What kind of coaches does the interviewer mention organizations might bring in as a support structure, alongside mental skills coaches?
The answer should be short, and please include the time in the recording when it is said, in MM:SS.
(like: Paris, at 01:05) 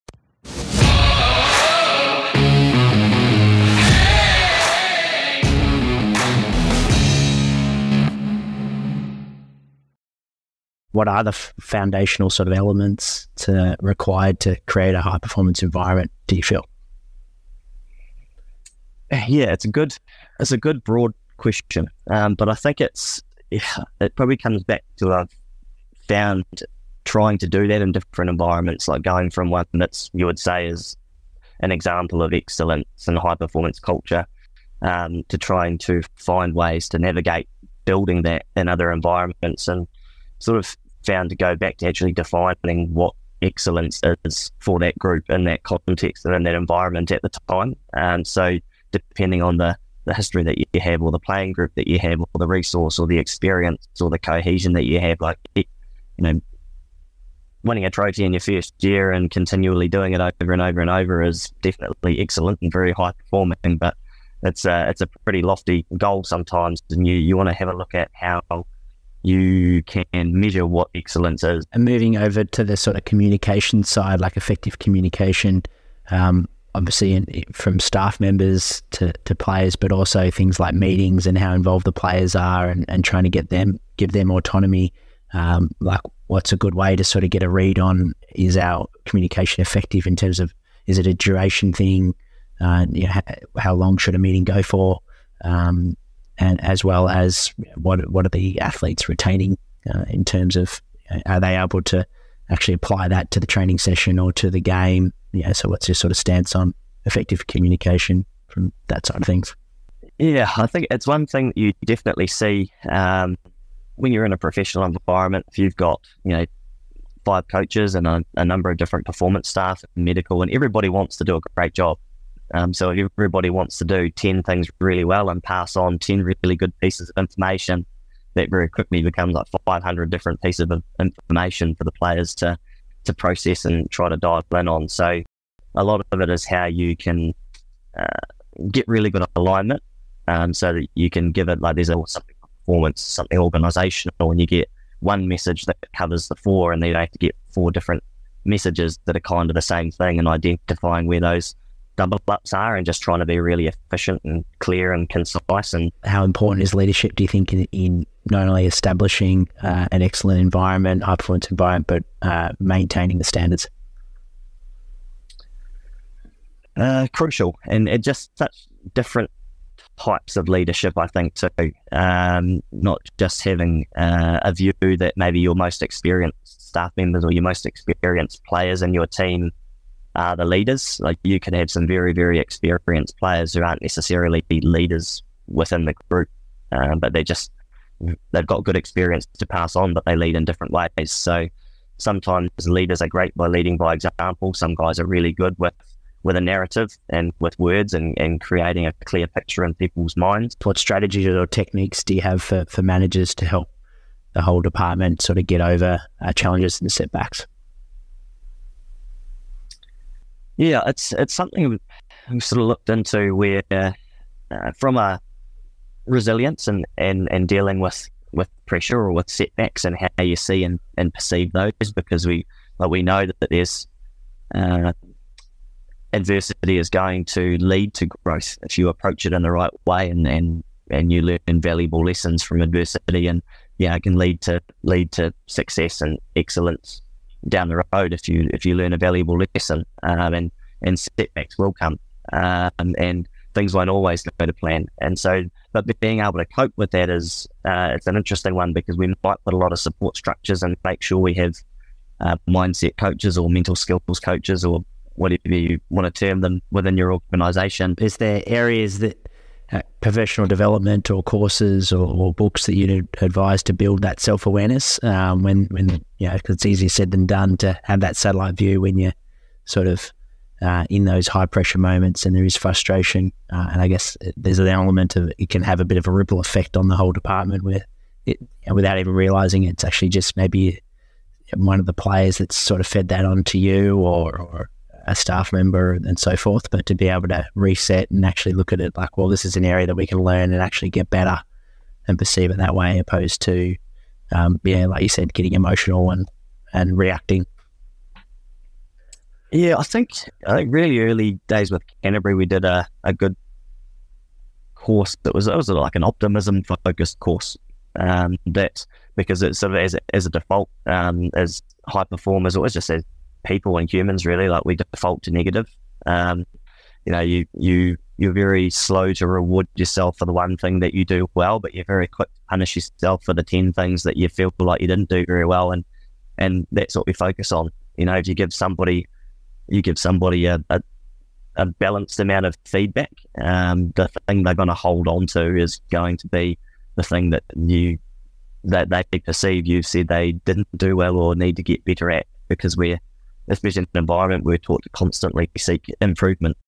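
Mindset coaches, at 04:12.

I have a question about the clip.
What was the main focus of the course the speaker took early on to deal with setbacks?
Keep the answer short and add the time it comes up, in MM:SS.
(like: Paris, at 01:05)
Optimism, at 05:06.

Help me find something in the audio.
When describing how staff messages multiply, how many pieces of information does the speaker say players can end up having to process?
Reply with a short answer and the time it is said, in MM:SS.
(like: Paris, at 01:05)
500, at 02:09.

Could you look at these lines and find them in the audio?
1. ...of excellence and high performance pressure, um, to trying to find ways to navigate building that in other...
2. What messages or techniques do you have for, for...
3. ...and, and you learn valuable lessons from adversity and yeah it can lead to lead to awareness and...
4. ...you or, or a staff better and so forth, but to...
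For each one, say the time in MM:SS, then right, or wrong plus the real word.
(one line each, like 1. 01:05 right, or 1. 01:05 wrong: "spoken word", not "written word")
1. 00:32 wrong: "culture", not "pressure"
2. 03:20 wrong: "strategies", not "messages"
3. 03:50 wrong: "success", not "awareness"
4. 04:43 wrong: "member", not "better".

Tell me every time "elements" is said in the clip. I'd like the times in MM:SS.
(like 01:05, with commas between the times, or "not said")
00:12, 04:34.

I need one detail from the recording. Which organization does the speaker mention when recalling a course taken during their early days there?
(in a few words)
Canterbury.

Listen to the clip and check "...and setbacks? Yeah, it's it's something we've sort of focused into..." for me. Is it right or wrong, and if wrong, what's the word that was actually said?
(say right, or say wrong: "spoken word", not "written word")
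wrong: "looked", not "focused".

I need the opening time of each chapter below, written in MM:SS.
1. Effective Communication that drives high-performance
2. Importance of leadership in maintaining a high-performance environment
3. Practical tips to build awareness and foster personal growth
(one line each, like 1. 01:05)
1. 01:11
2. 02:35
3. 04:18.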